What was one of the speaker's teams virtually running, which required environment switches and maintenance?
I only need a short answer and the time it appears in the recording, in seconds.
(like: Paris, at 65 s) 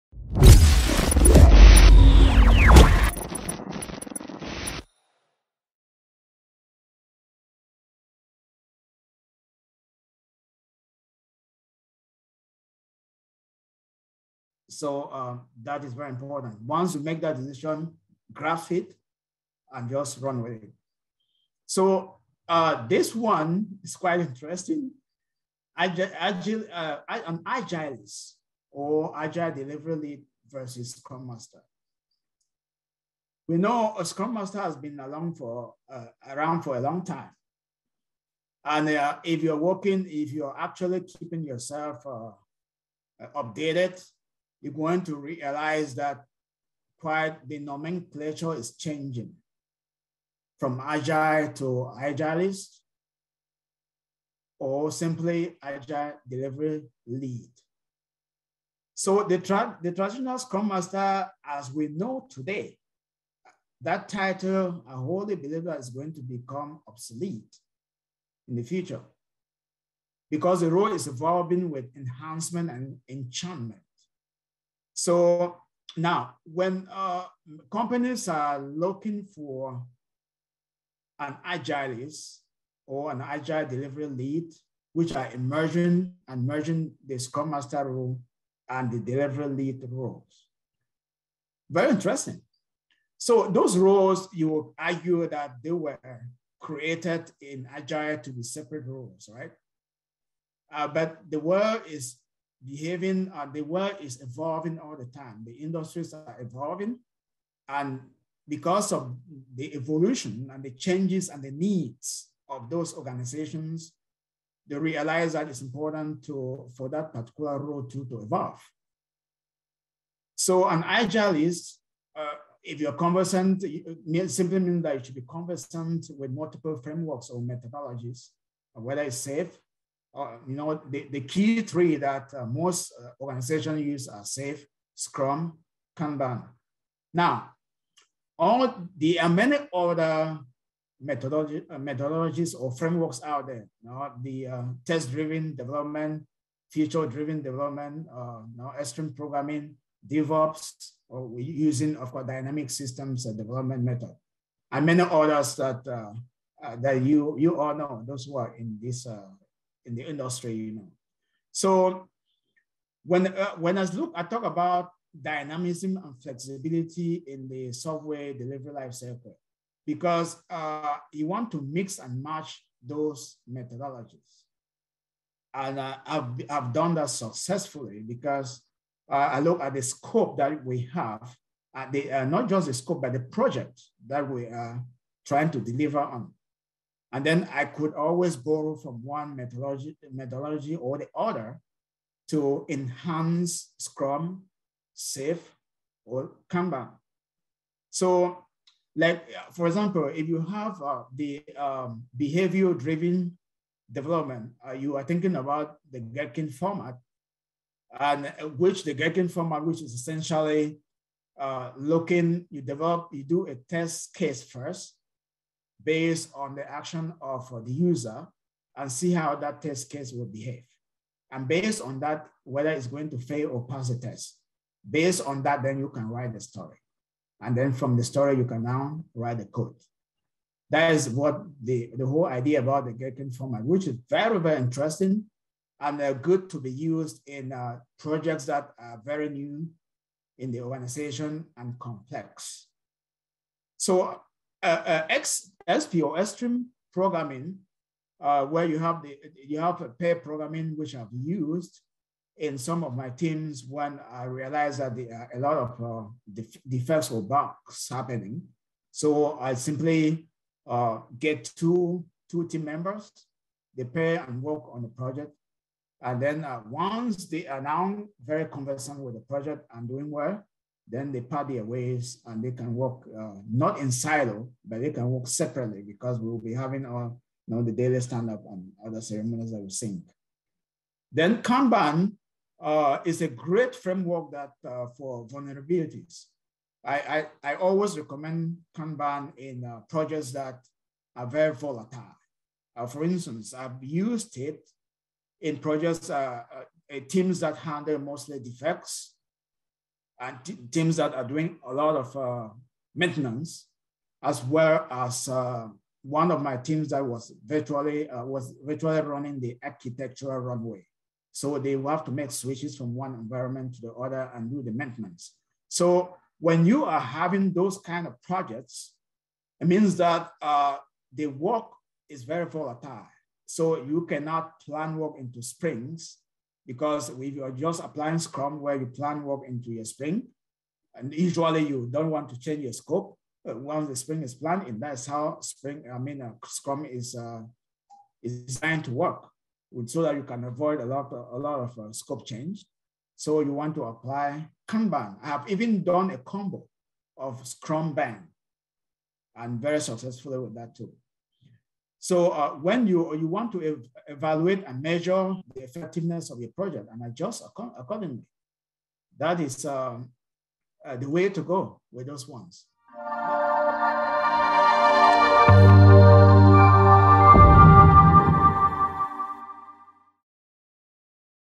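The architectural runway, at 309 s.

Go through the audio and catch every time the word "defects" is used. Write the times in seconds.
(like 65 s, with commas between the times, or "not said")
256 s, 298 s.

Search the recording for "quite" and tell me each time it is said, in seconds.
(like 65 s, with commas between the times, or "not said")
23 s, 46 s.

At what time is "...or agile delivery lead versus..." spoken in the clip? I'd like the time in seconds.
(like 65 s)
28 s.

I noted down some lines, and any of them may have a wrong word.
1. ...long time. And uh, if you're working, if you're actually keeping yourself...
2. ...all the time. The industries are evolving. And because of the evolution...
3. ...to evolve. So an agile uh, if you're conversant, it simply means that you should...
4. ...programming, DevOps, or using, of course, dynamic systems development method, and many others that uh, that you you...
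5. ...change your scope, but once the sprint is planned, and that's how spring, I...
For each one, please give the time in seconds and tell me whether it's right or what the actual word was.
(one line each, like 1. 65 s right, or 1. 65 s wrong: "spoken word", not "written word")
1. 36 s right
2. 104 s right
3. 118 s right
4. 149 s right
5. 332 s right.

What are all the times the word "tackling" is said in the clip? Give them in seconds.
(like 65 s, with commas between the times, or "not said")
not said.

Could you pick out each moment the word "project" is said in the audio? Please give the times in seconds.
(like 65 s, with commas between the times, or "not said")
183 s, 237 s, 264 s, 269 s, 289 s, 295 s, 318 s, 356 s.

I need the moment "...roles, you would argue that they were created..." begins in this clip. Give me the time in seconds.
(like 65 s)
93 s.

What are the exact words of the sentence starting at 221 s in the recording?
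And based on that, whether it's going to fail or pass the test, based on that, then you can write the story.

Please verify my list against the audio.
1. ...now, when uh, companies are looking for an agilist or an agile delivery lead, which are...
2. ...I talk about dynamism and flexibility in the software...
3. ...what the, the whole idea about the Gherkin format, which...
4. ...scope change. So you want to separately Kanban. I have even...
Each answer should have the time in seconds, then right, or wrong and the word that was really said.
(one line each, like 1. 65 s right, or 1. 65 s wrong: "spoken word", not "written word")
1. 75 s right
2. 164 s right
3. 231 s right
4. 341 s wrong: "apply", not "separately".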